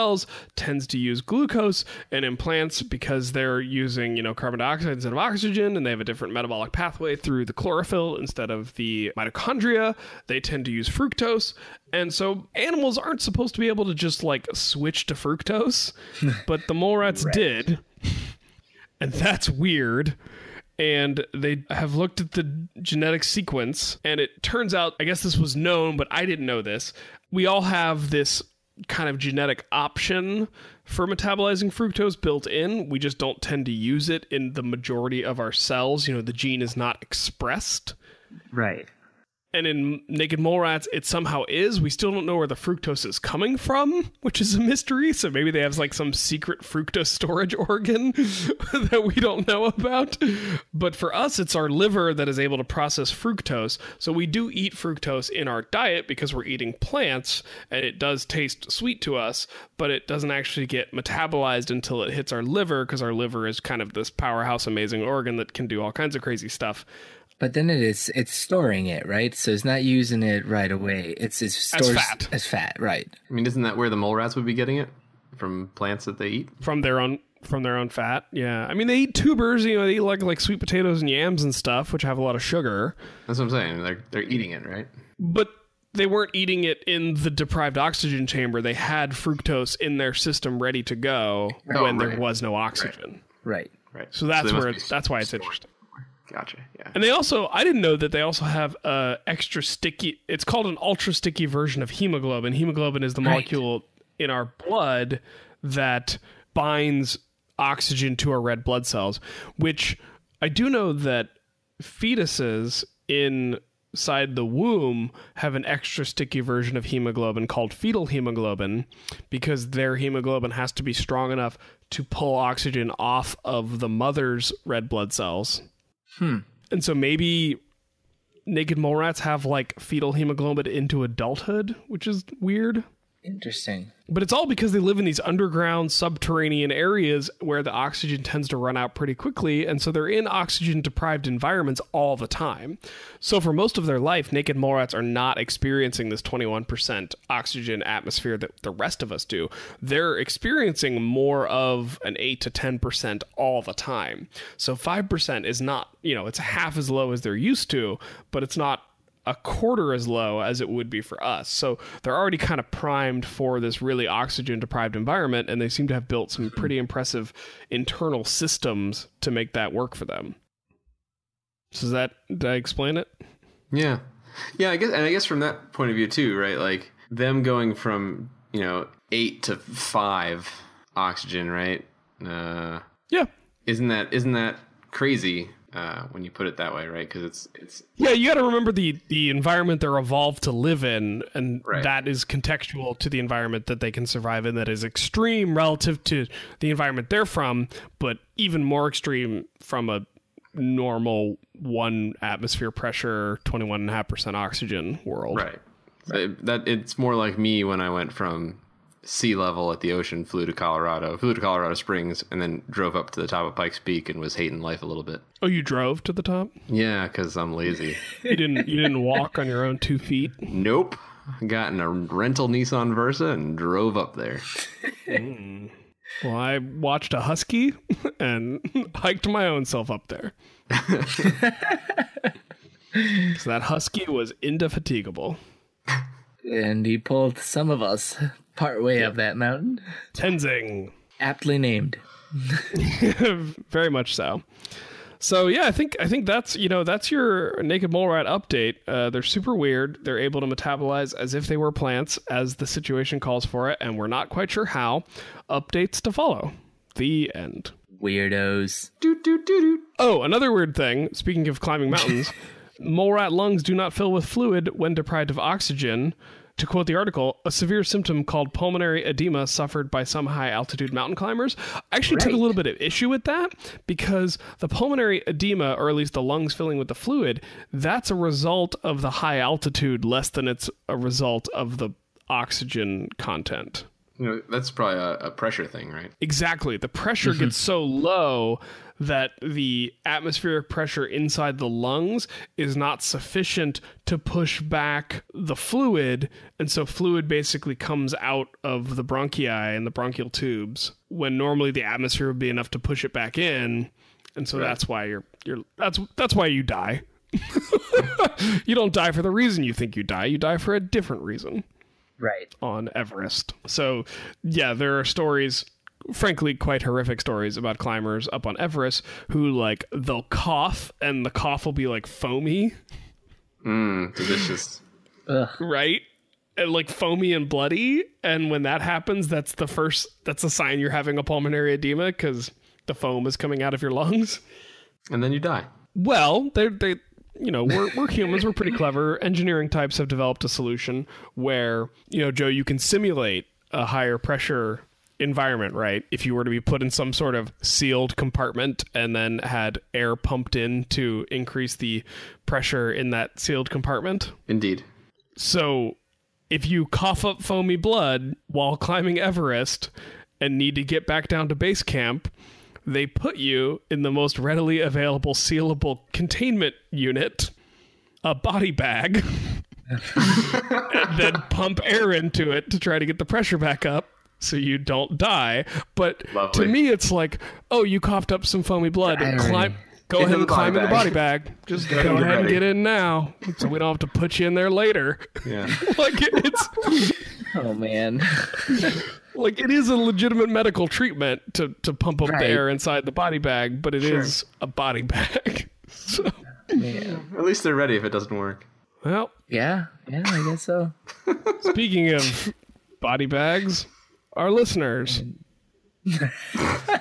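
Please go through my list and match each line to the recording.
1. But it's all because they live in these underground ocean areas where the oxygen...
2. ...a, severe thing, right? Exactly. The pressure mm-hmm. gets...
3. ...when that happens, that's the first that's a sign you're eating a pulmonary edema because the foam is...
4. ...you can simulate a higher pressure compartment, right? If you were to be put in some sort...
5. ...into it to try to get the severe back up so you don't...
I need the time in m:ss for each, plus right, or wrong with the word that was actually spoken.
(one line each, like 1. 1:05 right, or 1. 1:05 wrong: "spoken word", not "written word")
1. 2:14 wrong: "subterranean", not "ocean"
2. 4:45 wrong: "pressure", not "severe"
3. 5:28 wrong: "having", not "eating"
4. 5:42 wrong: "environment", not "compartment"
5. 6:12 wrong: "pressure", not "severe".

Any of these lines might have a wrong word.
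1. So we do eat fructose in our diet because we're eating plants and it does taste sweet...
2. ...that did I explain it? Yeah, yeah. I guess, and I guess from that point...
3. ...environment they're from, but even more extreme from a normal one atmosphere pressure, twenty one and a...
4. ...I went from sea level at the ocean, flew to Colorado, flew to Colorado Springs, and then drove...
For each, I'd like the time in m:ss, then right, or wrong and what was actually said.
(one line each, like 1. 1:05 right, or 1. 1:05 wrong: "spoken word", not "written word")
1. 0:53 right
2. 2:51 right
3. 3:16 right
4. 3:27 right.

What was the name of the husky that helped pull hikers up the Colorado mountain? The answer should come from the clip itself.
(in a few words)
Tenzing.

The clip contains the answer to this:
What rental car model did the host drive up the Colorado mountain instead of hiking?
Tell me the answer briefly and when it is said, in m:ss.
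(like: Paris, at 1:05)
Nissan Versa, at 3:42.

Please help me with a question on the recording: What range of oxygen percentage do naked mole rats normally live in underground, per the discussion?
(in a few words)
8 to 10%.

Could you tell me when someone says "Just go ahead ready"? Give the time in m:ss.
6:21.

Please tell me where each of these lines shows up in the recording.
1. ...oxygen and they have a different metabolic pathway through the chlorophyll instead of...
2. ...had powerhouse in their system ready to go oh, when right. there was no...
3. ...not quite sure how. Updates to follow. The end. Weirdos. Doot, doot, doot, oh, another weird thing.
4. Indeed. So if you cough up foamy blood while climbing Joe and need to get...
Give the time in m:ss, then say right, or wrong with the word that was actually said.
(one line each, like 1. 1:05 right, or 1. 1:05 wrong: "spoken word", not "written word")
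1. 0:05 right
2. 1:28 wrong: "fructose", not "powerhouse"
3. 4:14 right
4. 5:54 wrong: "Everest", not "Joe".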